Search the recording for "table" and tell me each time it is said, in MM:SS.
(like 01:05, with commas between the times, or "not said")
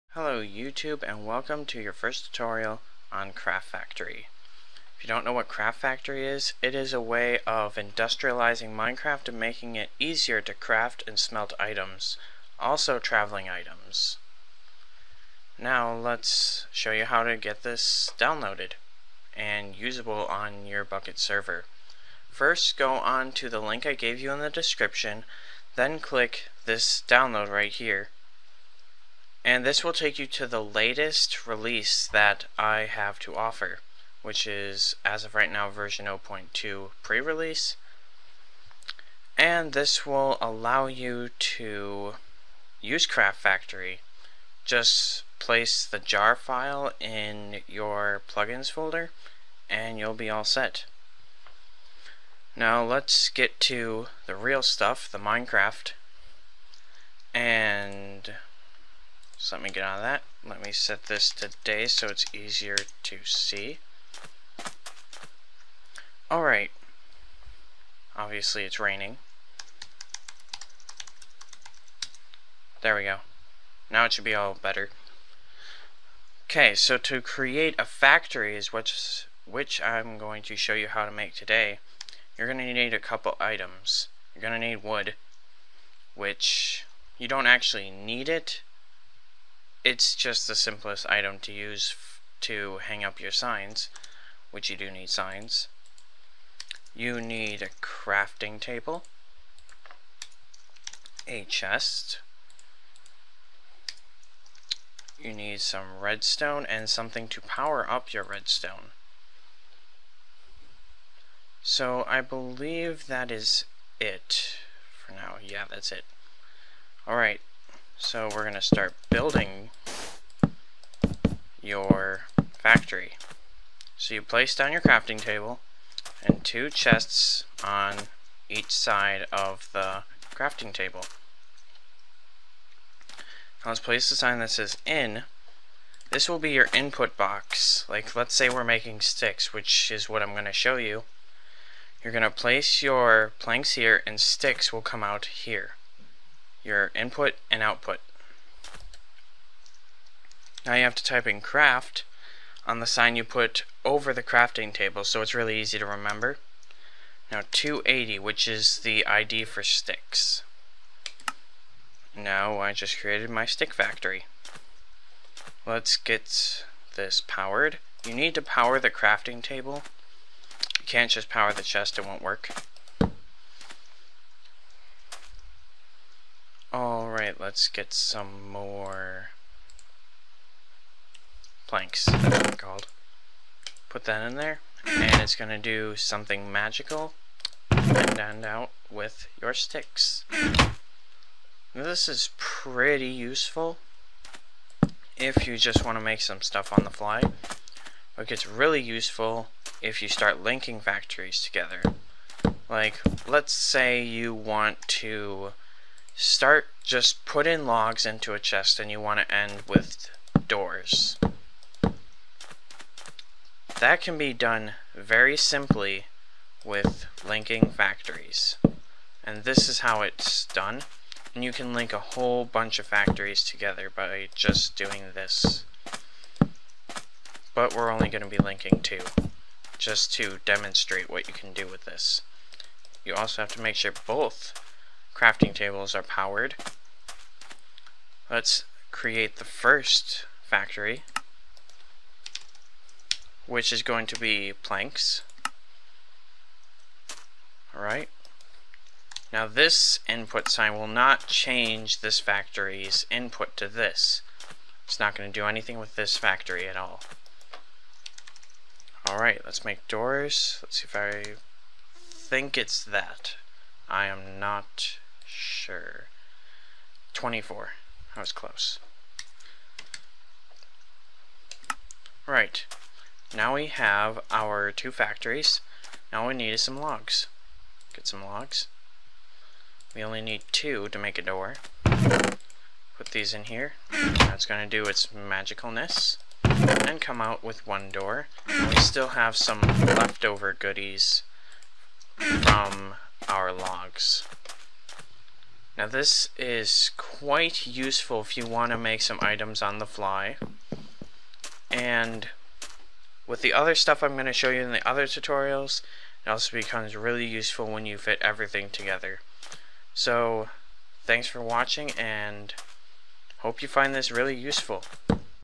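01:38, 02:05, 02:10, 02:34, 02:49, 03:55.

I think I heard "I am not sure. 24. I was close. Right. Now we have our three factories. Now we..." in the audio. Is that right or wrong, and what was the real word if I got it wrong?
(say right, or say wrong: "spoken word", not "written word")
wrong: "two", not "three".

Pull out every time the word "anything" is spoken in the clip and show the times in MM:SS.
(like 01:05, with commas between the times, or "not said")
04:15.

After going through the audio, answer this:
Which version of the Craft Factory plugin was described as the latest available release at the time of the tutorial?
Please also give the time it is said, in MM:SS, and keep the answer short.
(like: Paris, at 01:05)
0.2 pre-release, at 00:35.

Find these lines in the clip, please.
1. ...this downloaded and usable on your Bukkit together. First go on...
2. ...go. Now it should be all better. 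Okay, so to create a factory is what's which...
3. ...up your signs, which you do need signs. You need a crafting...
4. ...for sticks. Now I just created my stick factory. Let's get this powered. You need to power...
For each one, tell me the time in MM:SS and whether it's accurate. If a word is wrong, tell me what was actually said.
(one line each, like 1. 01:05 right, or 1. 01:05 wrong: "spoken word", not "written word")
1. 00:17 wrong: "server", not "together"
2. 01:13 right
3. 01:33 right
4. 02:39 right.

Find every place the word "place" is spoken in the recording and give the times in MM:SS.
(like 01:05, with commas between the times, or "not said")
00:45, 02:04, 02:13, 02:22.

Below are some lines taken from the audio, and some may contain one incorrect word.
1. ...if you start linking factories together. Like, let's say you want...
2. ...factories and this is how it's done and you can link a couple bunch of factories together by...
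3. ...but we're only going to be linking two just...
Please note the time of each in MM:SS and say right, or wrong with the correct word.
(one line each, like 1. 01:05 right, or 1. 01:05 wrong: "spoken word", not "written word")
1. 03:19 right
2. 03:37 wrong: "whole", not "couple"
3. 03:47 right.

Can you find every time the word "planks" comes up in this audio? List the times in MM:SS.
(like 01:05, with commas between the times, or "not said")
02:23, 03:01, 04:04.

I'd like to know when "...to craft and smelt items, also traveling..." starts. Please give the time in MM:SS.
00:10.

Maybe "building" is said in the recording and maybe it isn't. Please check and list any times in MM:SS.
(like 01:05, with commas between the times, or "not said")
01:59.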